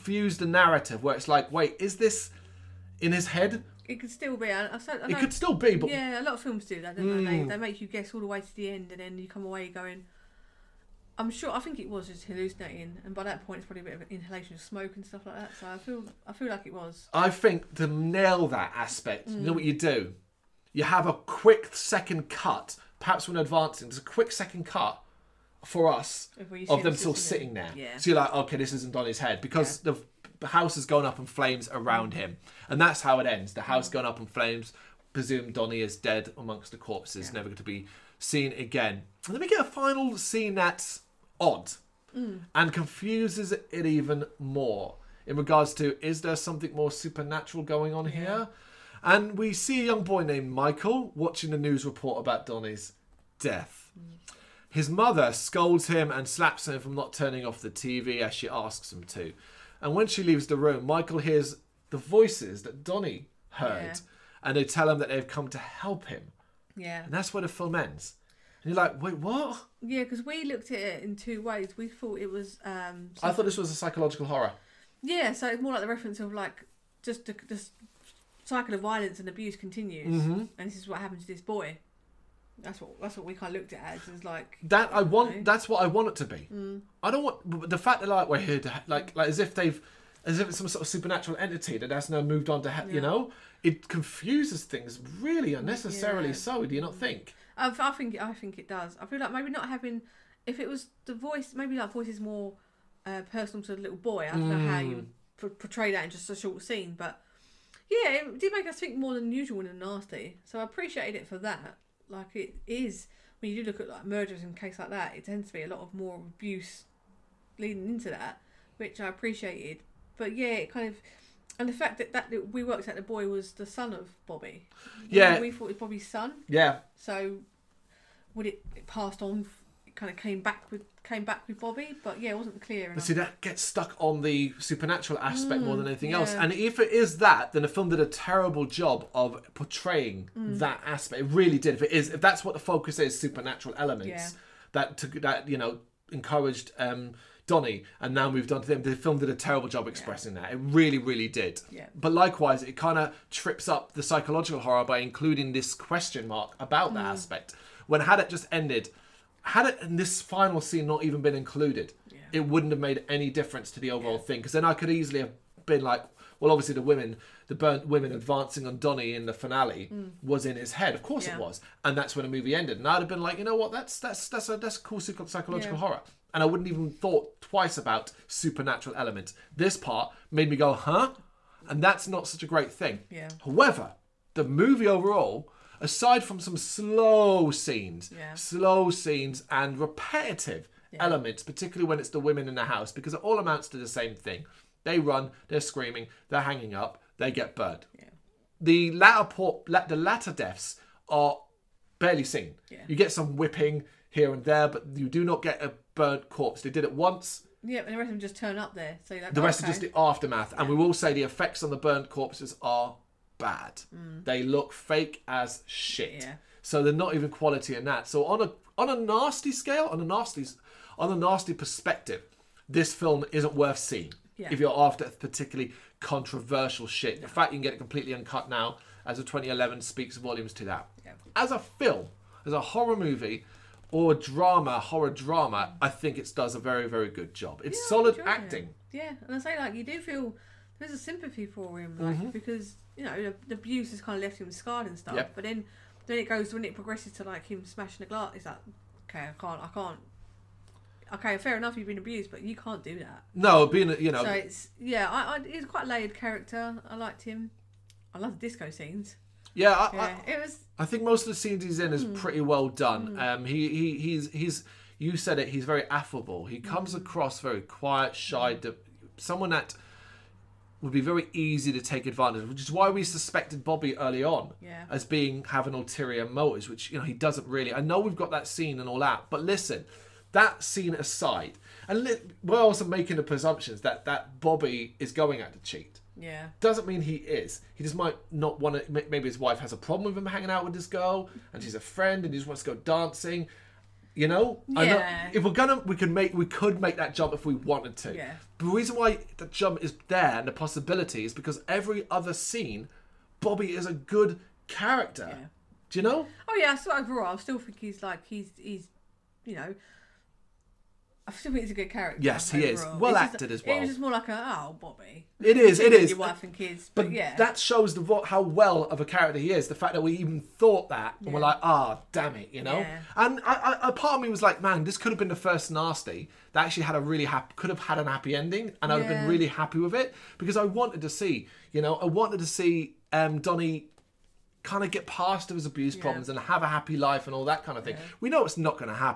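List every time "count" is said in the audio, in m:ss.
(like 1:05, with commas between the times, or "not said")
not said.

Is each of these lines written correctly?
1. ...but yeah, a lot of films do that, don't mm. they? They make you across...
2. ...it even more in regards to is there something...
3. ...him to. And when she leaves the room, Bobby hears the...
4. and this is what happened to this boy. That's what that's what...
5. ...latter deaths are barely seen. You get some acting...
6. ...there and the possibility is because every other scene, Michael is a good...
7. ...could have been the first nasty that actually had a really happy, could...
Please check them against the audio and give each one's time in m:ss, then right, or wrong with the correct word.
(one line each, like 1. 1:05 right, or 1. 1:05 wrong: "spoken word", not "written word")
1. 0:05 wrong: "guess", not "across"
2. 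0:43 right
3. 0:58 wrong: "Michael", not "Bobby"
4. 1:20 right
5. 3:19 wrong: "whipping", not "acting"
6. 5:00 wrong: "Bobby", not "Michael"
7. 5:24 right.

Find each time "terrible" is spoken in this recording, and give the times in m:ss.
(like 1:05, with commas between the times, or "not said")
2:18, 2:29.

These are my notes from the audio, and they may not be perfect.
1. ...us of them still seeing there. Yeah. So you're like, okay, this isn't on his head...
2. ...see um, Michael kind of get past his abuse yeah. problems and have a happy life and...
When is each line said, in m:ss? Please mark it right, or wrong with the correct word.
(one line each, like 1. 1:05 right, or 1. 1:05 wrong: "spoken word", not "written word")
1. 0:25 wrong: "sitting", not "seeing"
2. 5:32 wrong: "Donnie", not "Michael".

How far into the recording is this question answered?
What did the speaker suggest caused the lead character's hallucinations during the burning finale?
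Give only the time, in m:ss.
0:14.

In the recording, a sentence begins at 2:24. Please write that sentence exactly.
that took that you know encouraged um, Donnie, and now moved on to them.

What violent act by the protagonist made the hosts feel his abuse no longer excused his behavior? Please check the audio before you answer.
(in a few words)
smashing the glass.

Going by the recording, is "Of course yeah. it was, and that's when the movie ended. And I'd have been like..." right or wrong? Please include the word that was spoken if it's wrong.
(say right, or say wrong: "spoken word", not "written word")
right.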